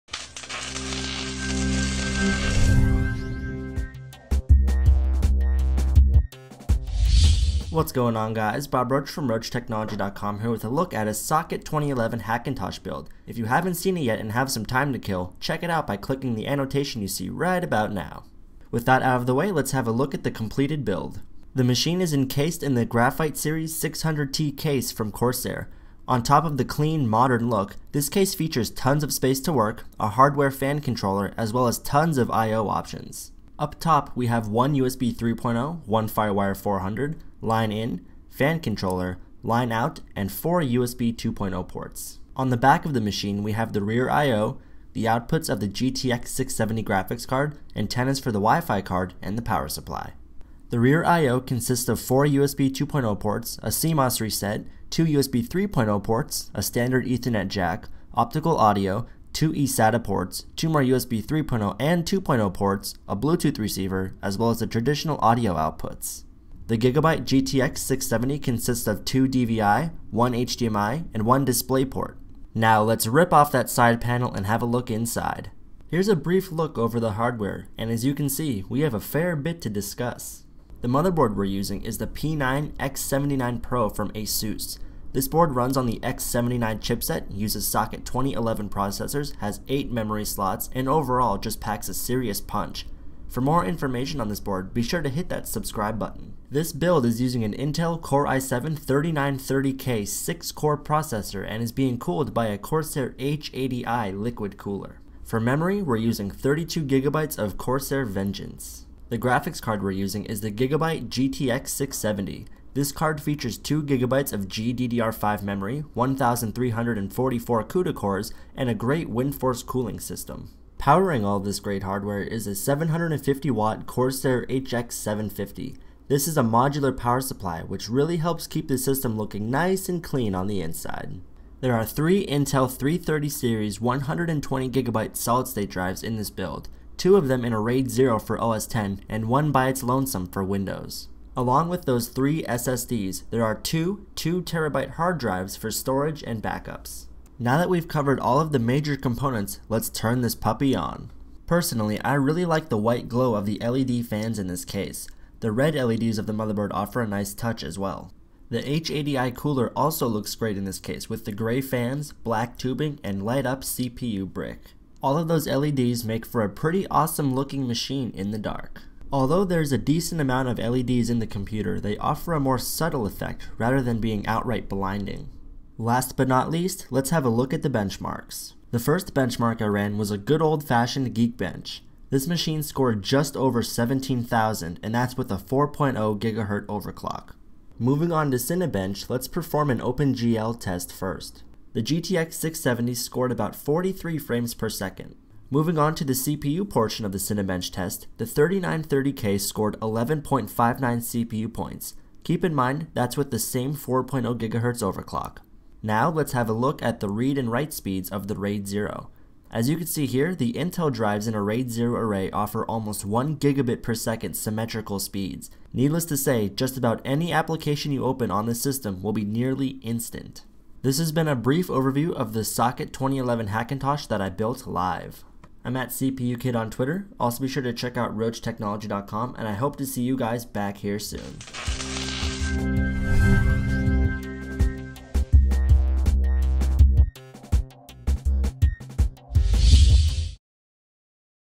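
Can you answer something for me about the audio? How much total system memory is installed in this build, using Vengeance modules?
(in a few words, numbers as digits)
32GB.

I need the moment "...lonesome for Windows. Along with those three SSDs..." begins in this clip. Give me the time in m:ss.
2:19.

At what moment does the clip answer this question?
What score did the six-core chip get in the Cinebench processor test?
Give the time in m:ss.
3:19.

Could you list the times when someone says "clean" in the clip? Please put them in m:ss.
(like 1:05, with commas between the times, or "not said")
0:26, 2:10.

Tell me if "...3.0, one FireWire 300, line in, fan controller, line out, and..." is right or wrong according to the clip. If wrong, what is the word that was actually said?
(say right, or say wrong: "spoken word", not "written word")
wrong: "400", not "300".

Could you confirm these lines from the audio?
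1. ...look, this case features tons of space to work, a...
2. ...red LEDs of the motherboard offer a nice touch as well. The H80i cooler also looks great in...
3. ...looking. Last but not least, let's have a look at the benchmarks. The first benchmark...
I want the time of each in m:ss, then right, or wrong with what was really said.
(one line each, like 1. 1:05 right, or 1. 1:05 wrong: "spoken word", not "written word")
1. 0:27 right
2. 2:35 right
3. 2:54 wrong: "blinding", not "looking".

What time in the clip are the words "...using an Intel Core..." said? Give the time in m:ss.
1:37.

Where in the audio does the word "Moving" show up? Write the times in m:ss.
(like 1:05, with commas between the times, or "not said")
3:07, 3:15.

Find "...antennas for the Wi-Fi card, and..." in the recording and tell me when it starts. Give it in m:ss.
0:47.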